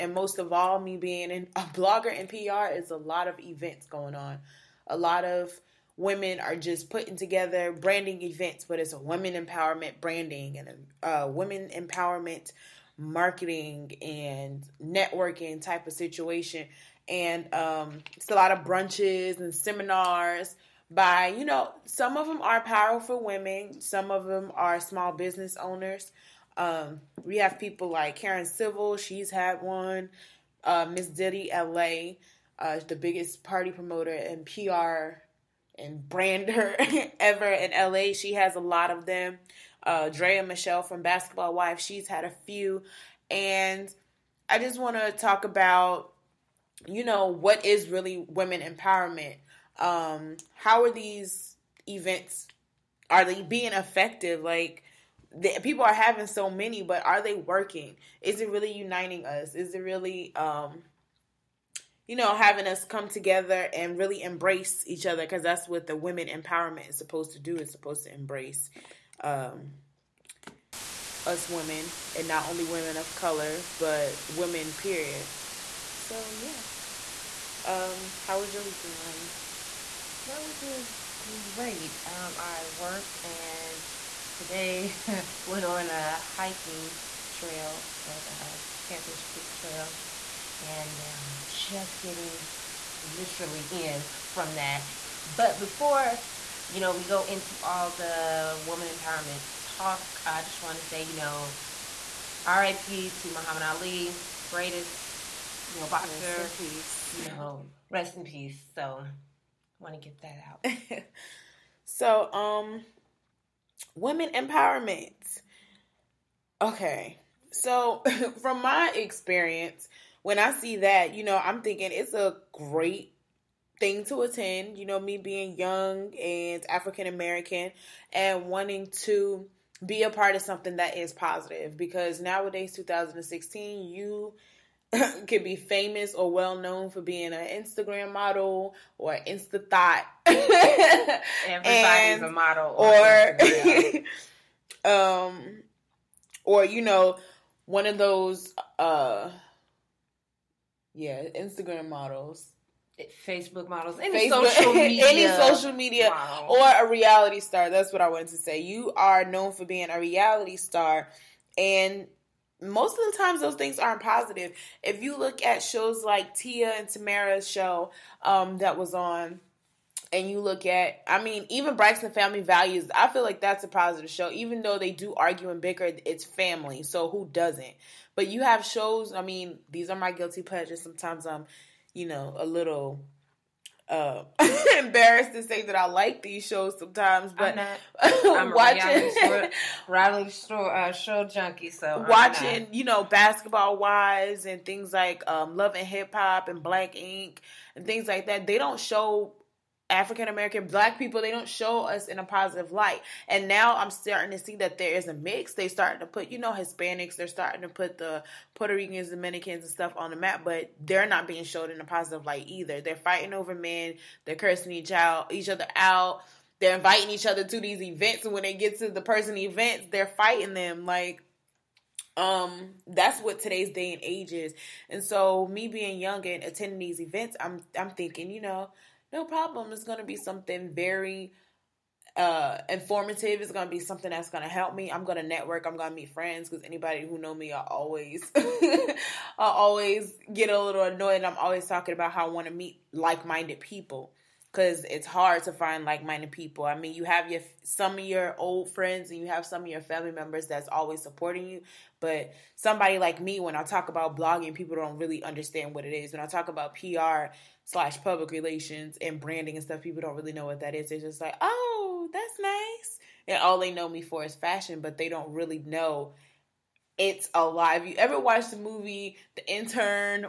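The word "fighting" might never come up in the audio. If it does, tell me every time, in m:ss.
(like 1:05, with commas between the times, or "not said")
3:32, 3:40.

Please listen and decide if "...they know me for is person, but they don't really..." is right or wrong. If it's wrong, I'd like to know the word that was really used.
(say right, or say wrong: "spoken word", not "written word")
wrong: "fashion", not "person".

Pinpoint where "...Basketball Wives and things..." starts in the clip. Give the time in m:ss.
3:13.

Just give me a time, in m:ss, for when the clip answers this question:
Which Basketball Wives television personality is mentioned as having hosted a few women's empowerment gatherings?
0:40.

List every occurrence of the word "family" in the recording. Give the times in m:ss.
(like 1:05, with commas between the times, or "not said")
2:52, 2:56, 4:09.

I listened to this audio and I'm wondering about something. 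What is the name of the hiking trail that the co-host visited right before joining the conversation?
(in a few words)
Panthers Creek Trail.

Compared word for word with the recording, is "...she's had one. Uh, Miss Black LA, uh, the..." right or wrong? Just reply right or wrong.
wrong.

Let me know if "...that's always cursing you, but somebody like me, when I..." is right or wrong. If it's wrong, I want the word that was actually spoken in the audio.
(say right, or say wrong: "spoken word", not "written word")
wrong: "supporting", not "cursing".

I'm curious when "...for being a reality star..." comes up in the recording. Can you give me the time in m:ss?
2:39.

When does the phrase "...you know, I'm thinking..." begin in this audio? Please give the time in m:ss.
2:01.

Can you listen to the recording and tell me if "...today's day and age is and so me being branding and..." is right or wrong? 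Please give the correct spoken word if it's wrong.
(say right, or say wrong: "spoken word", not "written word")
wrong: "young", not "branding".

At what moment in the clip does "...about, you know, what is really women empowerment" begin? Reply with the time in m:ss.
0:45.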